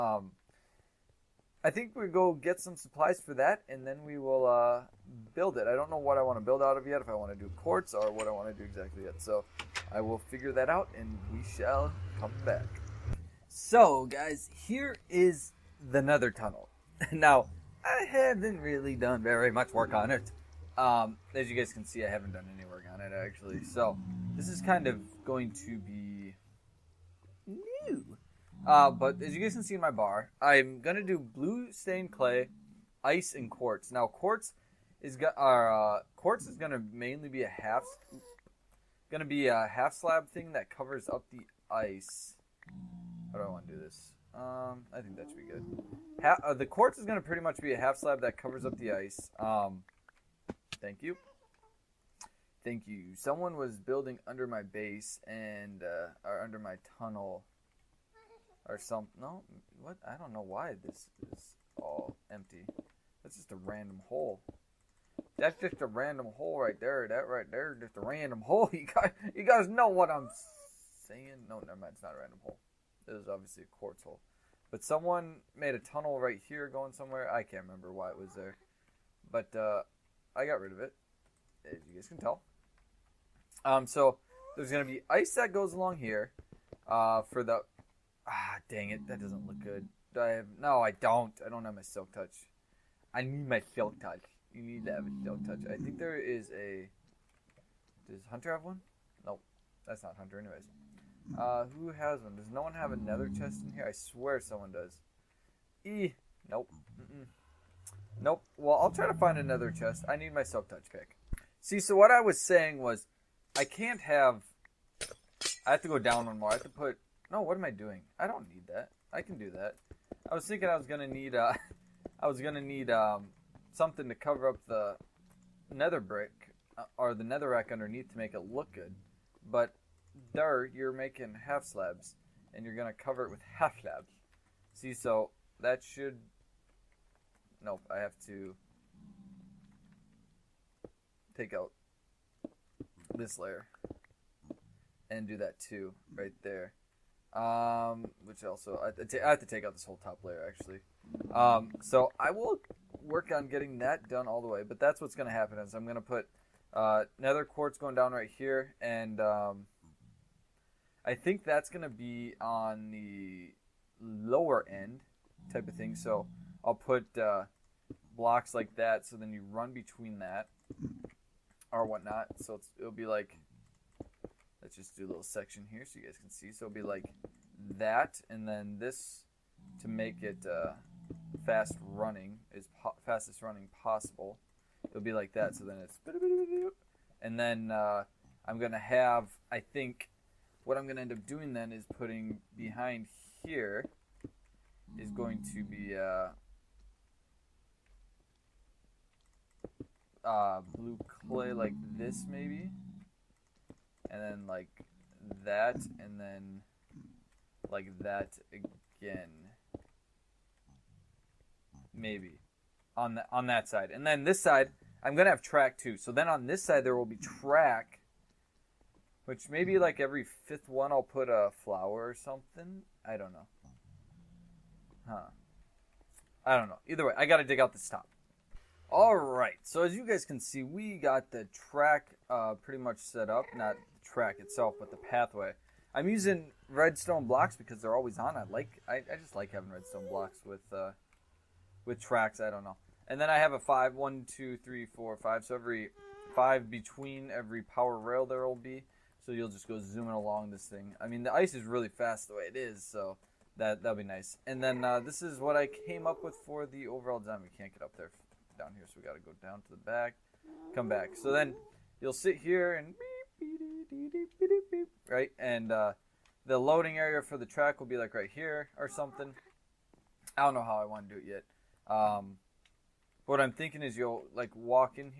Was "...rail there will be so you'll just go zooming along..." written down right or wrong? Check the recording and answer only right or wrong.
right.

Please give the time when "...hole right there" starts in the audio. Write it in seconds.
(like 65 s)
66 s.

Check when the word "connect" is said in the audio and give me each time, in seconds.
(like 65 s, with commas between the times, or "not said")
not said.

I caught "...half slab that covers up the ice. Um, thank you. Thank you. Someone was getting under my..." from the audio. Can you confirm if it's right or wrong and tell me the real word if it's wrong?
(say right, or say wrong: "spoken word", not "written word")
wrong: "building", not "getting".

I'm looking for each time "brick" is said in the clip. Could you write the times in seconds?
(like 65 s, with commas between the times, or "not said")
126 s.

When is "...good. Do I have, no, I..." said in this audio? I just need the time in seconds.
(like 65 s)
89 s.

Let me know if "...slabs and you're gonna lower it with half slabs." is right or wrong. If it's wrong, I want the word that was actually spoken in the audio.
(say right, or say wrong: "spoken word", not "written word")
wrong: "cover", not "lower".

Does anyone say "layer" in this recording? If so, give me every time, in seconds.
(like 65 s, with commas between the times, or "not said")
143 s, 150 s.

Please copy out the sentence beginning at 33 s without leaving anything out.
Now, quartz is, uh, quartz is going to mainly be a half...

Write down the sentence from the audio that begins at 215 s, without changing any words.
So then on this side there will be track which maybe like every fifth one I'll put a flower or something.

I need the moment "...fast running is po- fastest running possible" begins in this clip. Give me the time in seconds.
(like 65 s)
181 s.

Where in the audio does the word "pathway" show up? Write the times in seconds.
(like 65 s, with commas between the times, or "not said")
234 s.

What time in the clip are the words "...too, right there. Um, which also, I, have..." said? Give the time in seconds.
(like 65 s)
145 s.